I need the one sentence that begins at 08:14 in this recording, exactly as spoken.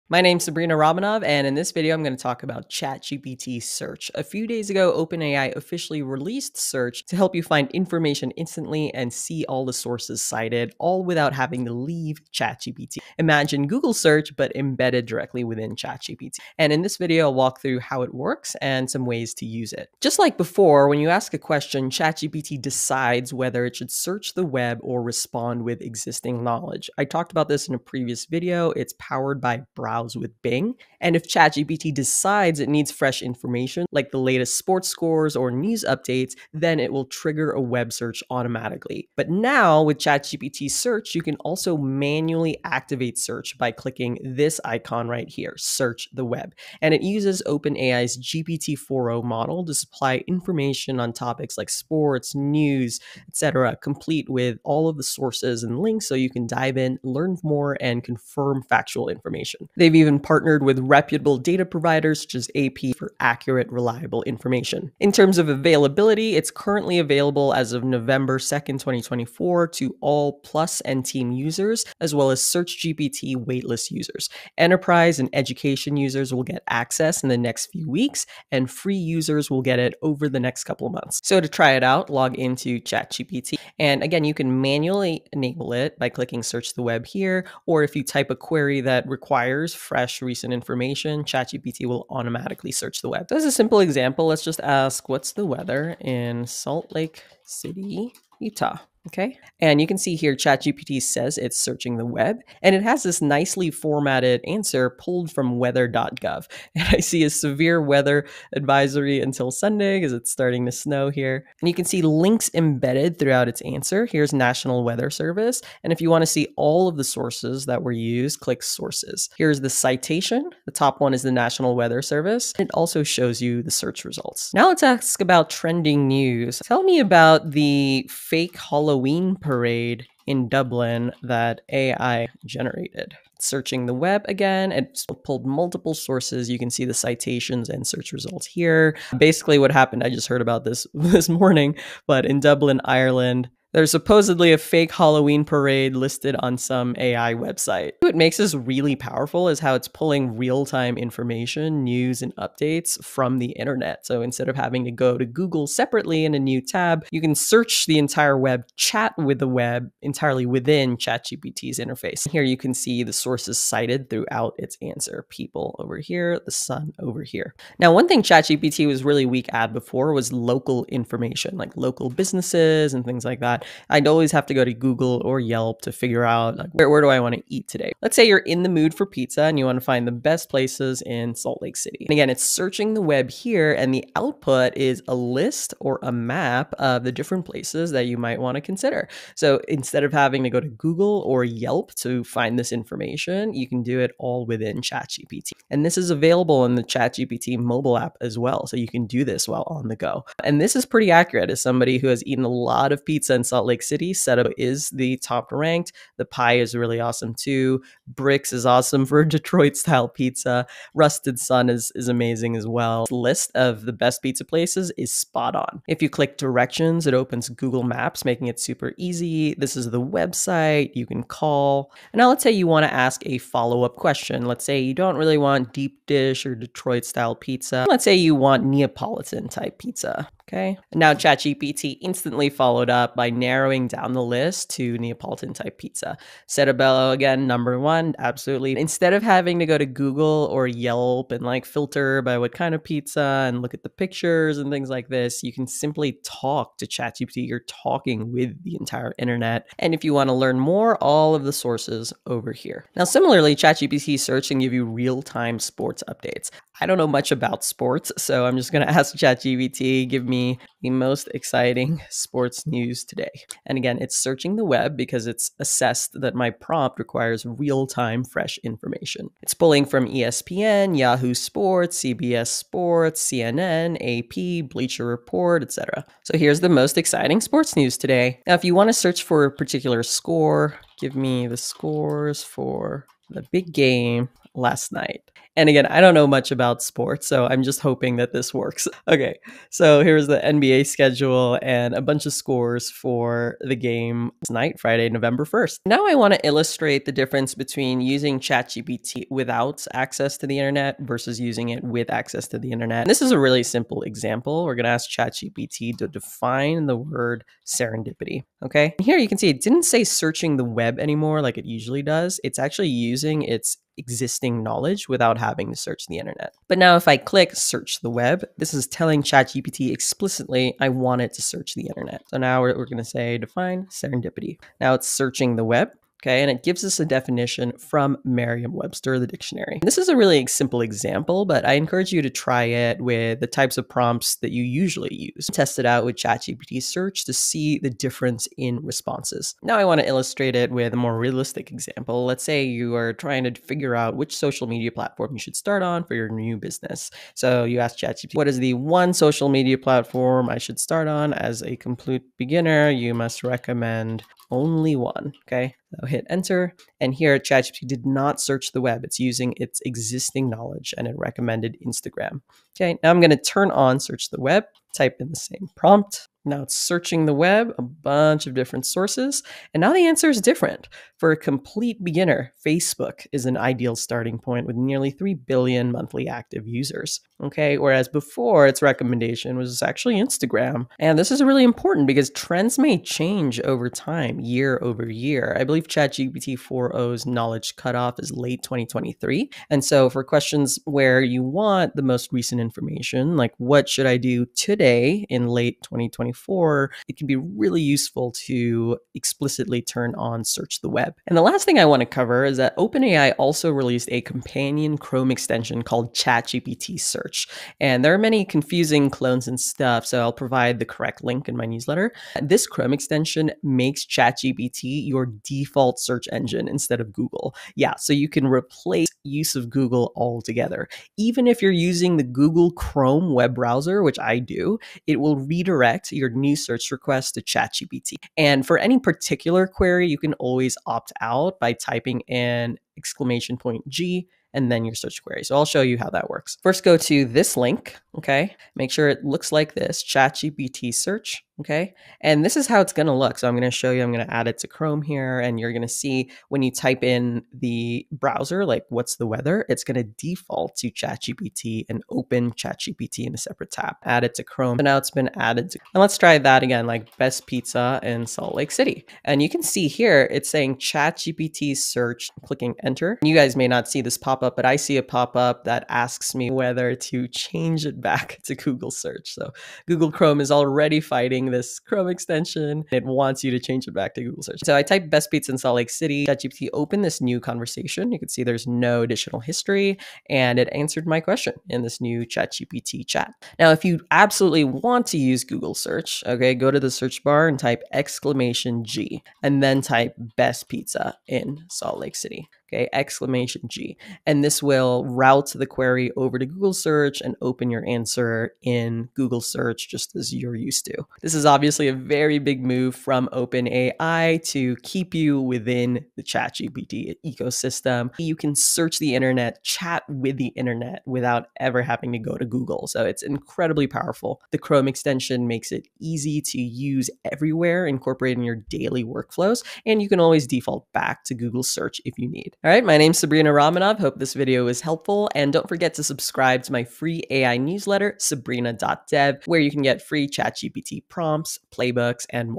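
And this will route the query over to Google search and open your answer in Google search just as you're used to.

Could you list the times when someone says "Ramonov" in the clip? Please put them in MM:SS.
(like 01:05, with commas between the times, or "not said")
00:00, 08:43.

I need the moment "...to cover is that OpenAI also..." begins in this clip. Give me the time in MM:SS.
06:42.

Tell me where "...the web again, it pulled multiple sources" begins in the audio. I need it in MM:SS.
02:13.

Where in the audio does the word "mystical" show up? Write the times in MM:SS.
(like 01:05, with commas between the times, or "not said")
not said.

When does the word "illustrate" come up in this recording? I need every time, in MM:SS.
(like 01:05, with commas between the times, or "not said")
04:56, 05:40.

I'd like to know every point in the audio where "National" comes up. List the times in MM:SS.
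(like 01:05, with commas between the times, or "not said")
01:54, 02:01.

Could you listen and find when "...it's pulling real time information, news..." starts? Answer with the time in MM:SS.
02:29.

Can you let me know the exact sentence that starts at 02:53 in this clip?
I'd always have to go to Google or Yelp to figure out like, where, where do I want to eat today.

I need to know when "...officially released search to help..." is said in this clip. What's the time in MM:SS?
00:05.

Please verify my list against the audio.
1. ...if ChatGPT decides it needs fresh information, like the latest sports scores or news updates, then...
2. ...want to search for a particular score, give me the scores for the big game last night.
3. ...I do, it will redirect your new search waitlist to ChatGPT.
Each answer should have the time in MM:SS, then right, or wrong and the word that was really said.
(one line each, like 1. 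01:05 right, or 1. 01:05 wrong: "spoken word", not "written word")
1. 00:31 right
2. 04:38 right
3. 07:04 wrong: "request", not "waitlist".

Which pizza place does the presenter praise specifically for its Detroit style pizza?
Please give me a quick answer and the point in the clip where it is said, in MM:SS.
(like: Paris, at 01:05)
Bricks, at 03:28.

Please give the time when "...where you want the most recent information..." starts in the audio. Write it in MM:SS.
06:30.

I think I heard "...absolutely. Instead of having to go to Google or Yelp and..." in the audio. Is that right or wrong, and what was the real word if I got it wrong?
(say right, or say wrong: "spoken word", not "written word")
right.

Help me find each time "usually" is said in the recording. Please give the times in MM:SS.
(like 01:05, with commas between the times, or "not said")
05:11, 05:34.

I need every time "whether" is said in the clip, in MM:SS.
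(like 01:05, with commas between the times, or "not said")
00:23, 07:46.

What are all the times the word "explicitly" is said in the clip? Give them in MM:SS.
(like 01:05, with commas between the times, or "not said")
05:19, 06:39.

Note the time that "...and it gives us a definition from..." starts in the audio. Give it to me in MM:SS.
05:26.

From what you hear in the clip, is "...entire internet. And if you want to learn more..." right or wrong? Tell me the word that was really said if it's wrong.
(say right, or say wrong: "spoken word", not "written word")
right.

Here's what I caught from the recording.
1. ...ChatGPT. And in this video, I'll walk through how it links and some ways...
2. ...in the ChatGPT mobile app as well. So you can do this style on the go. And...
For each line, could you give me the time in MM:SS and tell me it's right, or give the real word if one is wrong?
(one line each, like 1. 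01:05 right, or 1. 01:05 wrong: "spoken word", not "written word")
1. 00:15 wrong: "works", not "links"
2. 03:16 wrong: "while", not "style".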